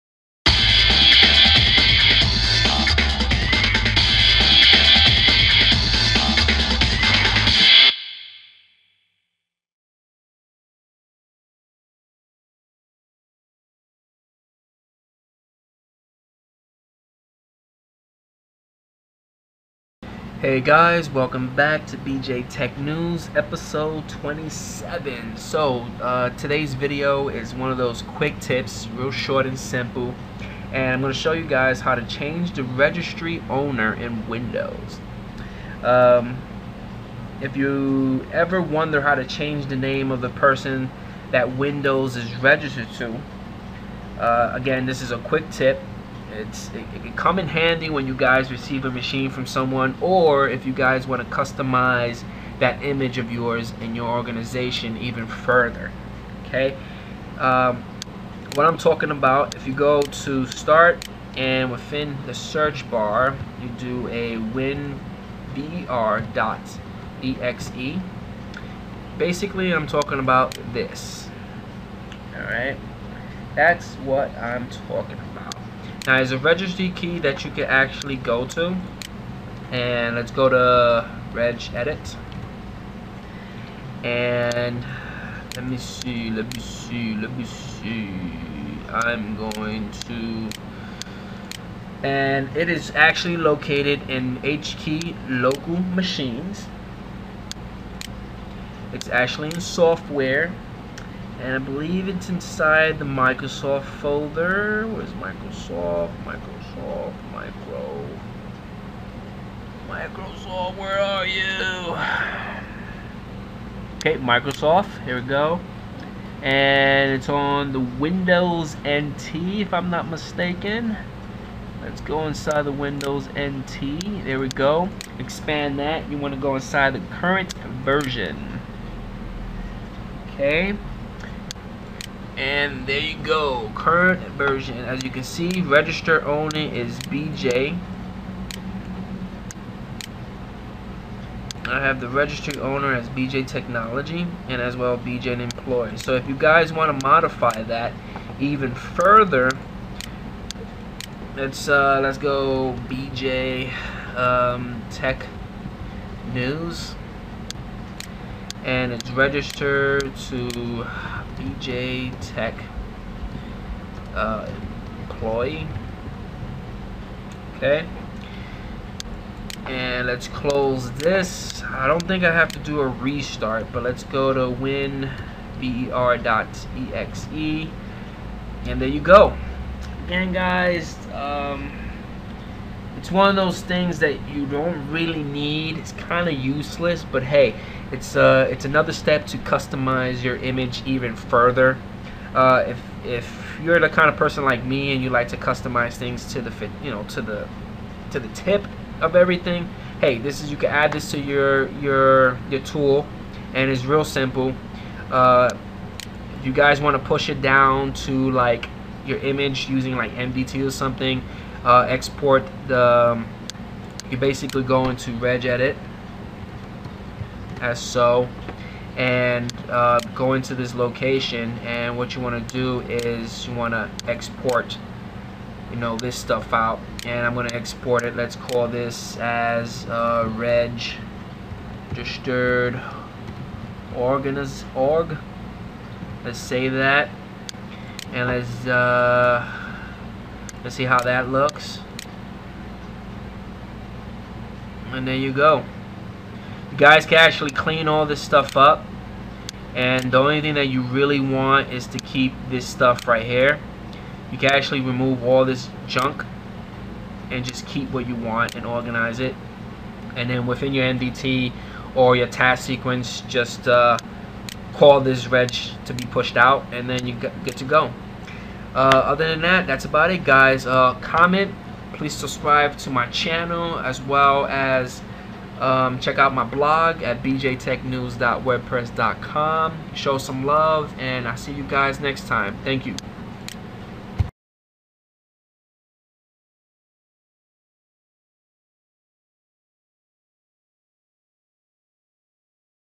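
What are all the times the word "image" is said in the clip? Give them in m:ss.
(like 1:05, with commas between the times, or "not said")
0:52, 3:10, 3:29.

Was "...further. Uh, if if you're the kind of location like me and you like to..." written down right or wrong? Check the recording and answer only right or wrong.
wrong.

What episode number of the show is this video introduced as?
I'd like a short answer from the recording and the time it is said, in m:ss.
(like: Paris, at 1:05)
27, at 0:23.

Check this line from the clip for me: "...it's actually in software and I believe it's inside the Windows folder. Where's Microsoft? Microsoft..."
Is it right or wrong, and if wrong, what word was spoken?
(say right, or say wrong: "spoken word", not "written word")
wrong: "Microsoft", not "Windows".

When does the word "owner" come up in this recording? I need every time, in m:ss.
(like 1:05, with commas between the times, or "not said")
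0:33, 2:16, 2:22.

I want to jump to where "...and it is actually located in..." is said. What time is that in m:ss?
1:32.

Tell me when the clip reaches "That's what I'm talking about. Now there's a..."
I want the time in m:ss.
1:13.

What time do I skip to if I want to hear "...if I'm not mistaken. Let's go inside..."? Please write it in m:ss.
1:59.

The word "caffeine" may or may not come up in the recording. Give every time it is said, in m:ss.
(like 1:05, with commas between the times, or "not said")
not said.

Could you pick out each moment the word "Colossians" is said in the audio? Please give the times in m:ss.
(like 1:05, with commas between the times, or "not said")
not said.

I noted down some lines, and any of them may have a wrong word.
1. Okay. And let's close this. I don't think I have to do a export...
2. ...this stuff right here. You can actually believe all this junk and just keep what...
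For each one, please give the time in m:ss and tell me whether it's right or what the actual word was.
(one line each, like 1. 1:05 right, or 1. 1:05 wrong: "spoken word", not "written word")
1. 2:47 wrong: "restart", not "export"
2. 4:12 wrong: "remove", not "believe".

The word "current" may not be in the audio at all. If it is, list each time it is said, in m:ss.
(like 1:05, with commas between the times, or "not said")
2:07, 2:13.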